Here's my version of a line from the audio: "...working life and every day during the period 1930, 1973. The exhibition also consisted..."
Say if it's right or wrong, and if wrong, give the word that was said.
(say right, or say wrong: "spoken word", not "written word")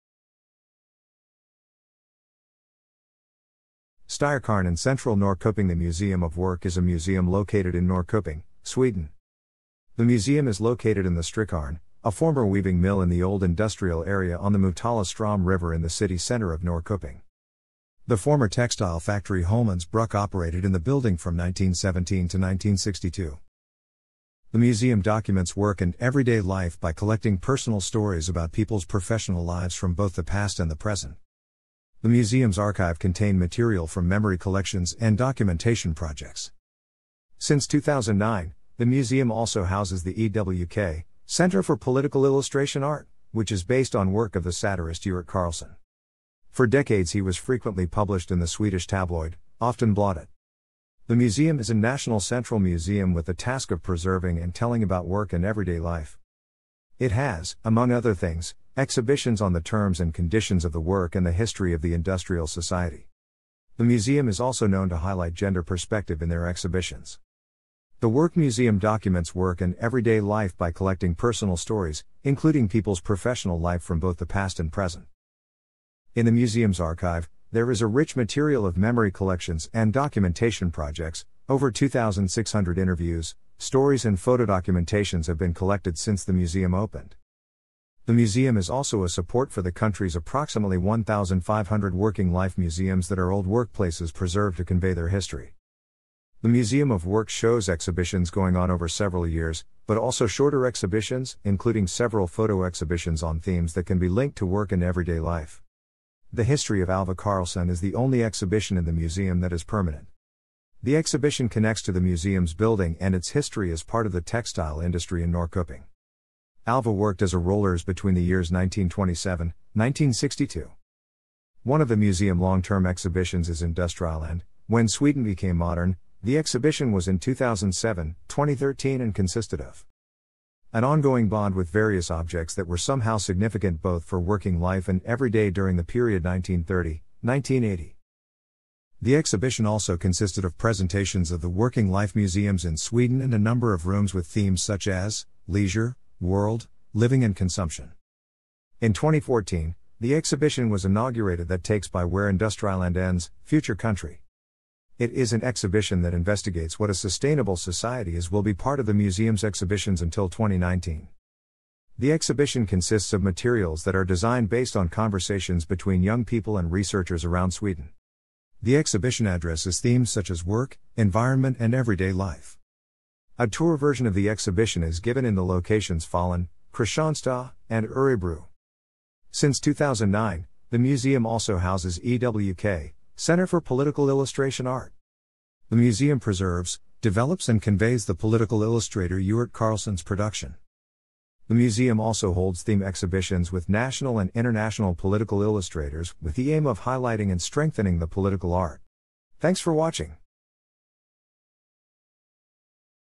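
wrong: "1980", not "1973".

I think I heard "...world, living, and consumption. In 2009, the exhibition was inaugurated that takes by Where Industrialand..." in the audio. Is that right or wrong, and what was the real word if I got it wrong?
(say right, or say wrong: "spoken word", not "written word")
wrong: "2014", not "2009".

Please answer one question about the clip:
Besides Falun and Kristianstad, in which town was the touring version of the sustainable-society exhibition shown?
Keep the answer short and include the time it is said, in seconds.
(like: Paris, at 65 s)
Örebro, at 177 s.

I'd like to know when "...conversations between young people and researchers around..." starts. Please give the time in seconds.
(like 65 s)
164 s.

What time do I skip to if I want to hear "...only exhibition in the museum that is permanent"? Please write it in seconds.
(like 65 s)
107 s.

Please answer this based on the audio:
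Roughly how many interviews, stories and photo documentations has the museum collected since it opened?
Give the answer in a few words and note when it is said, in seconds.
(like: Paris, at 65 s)
2,600, at 81 s.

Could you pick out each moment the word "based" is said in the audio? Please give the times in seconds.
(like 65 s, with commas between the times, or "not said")
43 s, 164 s.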